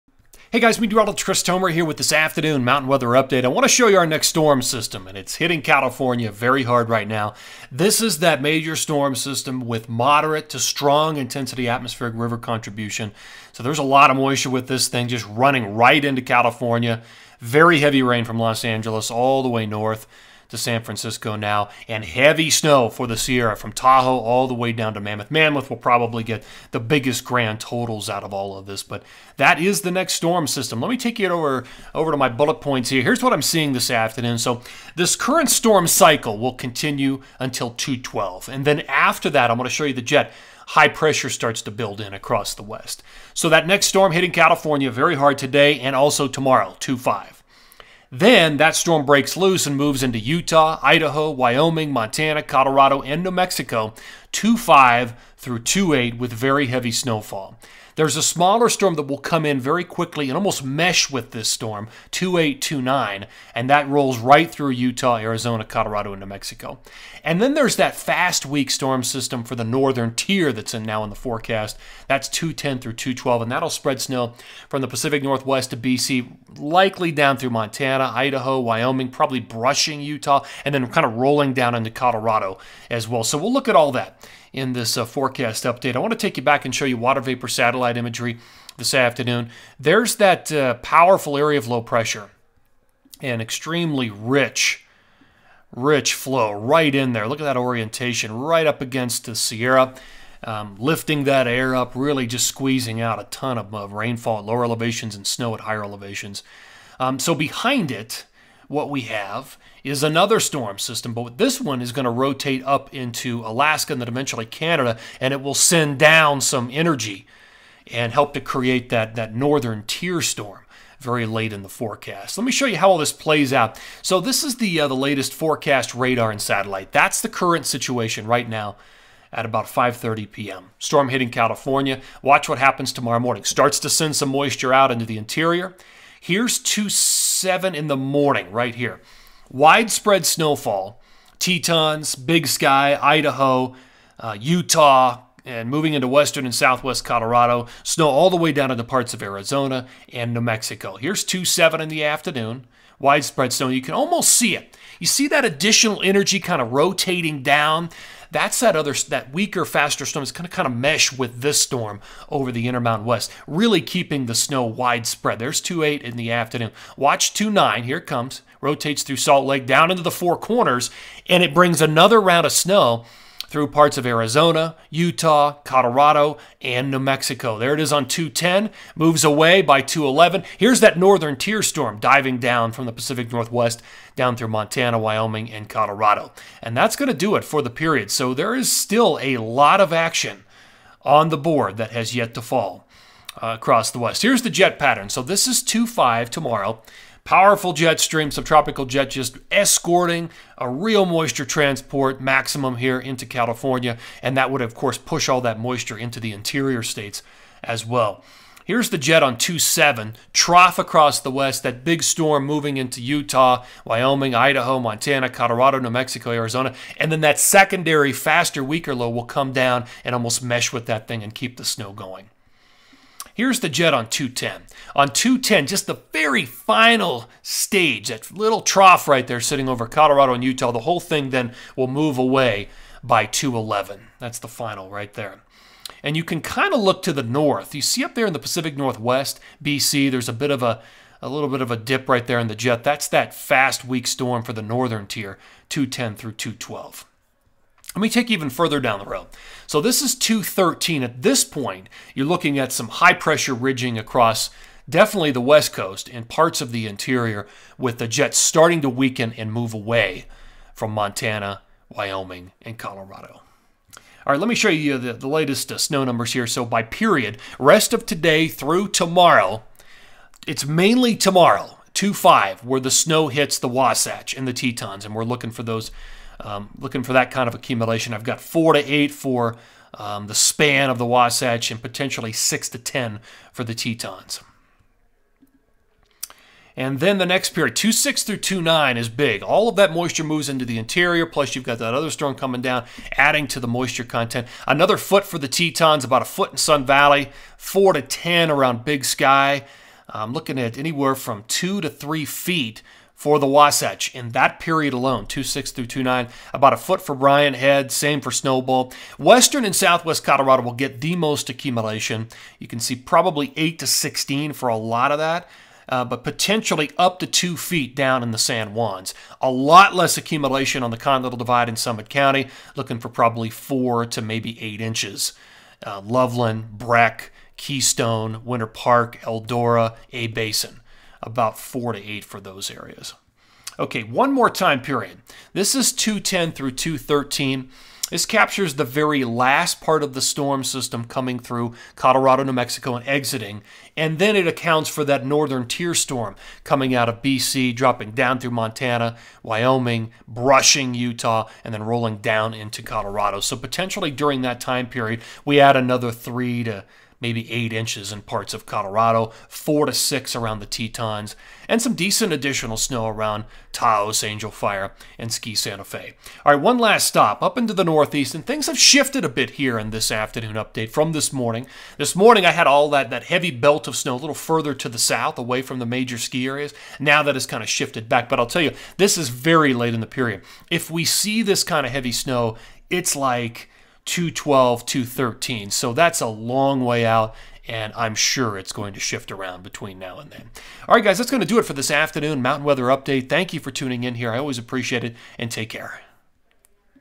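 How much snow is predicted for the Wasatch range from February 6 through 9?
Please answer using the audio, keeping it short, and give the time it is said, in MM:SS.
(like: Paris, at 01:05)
2 to 3 feet, at 05:01.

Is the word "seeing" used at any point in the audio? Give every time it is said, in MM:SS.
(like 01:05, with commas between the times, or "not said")
00:33.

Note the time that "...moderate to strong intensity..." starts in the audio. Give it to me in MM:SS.
00:09.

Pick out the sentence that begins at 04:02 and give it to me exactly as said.
That's that fast, weak storm for the northern tier, 210 through 212.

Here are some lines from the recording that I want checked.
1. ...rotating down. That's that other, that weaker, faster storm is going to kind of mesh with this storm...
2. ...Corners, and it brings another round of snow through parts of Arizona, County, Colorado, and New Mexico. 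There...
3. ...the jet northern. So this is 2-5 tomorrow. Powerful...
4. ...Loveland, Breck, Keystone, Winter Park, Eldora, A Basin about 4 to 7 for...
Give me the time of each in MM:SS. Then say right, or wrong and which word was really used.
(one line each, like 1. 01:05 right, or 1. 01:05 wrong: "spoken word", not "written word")
1. 02:36 right
2. 02:50 wrong: "Utah", not "County"
3. 03:14 wrong: "pattern", not "northern"
4. 05:26 wrong: "8", not "7".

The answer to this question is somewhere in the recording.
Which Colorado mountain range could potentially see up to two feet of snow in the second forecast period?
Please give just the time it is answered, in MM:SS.
05:18.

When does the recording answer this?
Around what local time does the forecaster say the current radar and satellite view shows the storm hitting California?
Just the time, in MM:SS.
02:09.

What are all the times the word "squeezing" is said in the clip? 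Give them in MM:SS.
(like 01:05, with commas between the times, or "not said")
01:42.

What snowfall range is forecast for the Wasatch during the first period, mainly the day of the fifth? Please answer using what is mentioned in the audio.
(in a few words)
4 to 8 inches.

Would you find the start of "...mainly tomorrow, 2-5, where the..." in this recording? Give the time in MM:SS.
04:30.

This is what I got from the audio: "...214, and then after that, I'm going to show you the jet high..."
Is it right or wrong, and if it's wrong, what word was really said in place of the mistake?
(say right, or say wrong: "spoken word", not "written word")
wrong: "212", not "214".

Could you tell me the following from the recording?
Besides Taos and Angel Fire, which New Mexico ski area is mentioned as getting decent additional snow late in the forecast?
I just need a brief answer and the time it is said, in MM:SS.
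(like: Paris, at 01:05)
Ski Santa Fe, at 06:05.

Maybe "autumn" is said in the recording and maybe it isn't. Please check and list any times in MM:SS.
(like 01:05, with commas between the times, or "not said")
not said.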